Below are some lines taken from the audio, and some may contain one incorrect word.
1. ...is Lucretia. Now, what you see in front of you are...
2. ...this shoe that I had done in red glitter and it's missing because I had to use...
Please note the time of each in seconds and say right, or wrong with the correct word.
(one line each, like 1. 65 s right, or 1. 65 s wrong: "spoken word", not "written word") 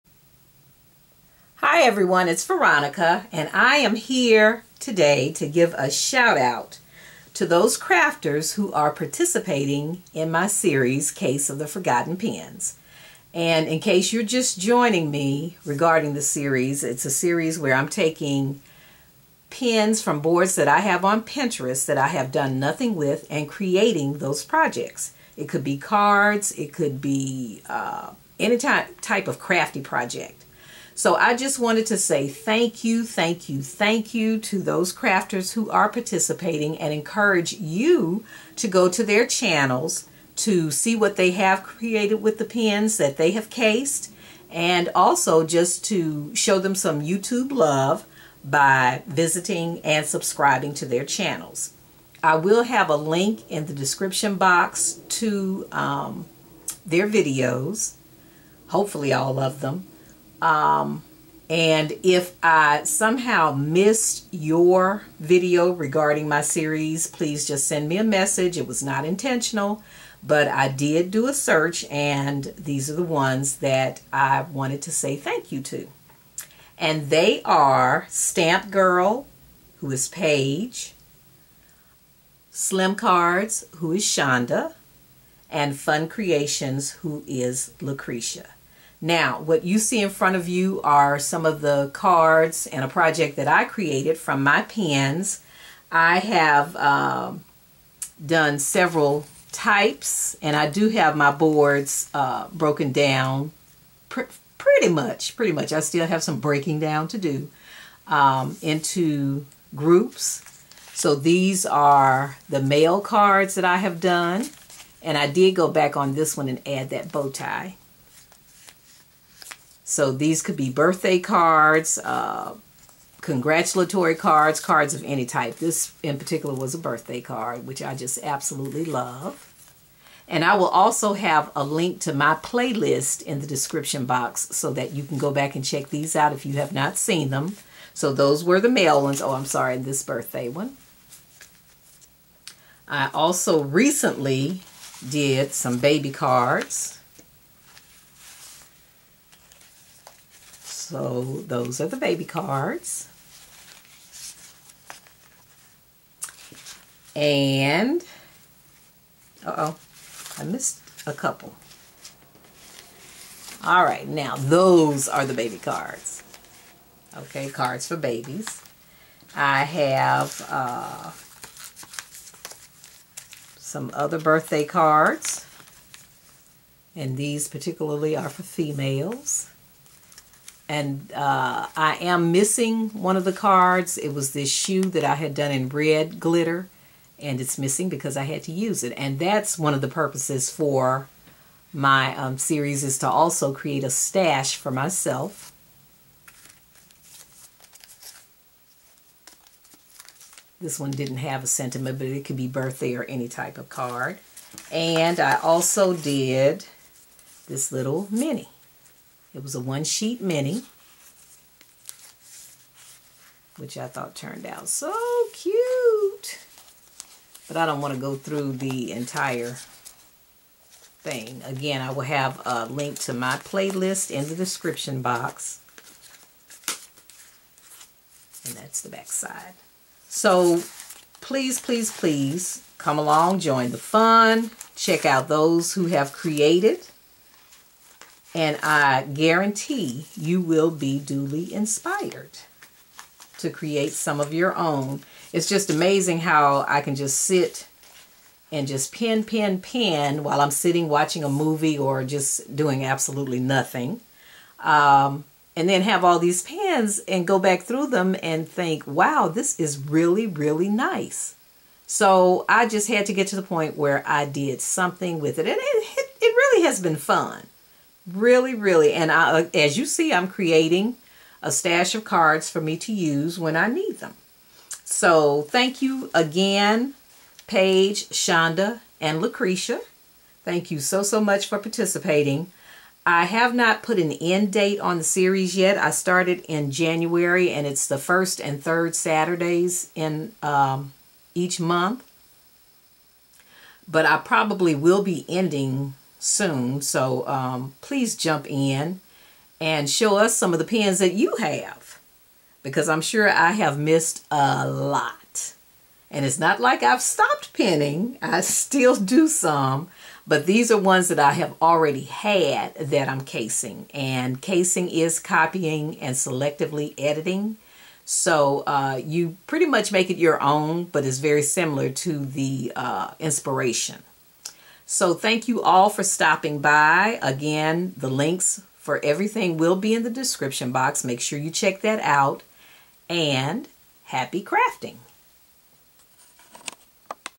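1. 87 s right
2. 184 s right.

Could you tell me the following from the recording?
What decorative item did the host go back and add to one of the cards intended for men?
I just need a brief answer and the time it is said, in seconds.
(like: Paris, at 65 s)
bow tie, at 117 s.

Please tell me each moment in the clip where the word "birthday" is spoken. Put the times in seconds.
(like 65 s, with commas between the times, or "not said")
120 s, 126 s, 140 s, 174 s, 202 s.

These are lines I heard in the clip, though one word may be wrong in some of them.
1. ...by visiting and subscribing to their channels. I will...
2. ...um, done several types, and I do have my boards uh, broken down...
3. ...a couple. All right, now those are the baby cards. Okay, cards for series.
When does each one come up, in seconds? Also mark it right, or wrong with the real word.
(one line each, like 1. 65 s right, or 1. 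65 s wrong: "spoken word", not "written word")
1. 48 s right
2. 96 s right
3. 161 s wrong: "babies", not "series".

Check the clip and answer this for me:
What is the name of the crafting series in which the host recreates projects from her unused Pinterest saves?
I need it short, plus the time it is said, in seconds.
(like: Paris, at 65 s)
Case of the Forgotten Pins, at 11 s.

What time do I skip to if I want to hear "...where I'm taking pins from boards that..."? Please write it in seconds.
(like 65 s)
17 s.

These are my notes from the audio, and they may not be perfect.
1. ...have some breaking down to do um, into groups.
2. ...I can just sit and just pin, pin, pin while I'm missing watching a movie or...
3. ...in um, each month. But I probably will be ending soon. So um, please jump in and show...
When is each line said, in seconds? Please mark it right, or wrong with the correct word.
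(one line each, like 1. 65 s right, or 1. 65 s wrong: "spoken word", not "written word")
1. 106 s right
2. 246 s wrong: "sitting", not "missing"
3. 289 s right.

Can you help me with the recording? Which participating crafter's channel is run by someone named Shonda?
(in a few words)
Slimcards.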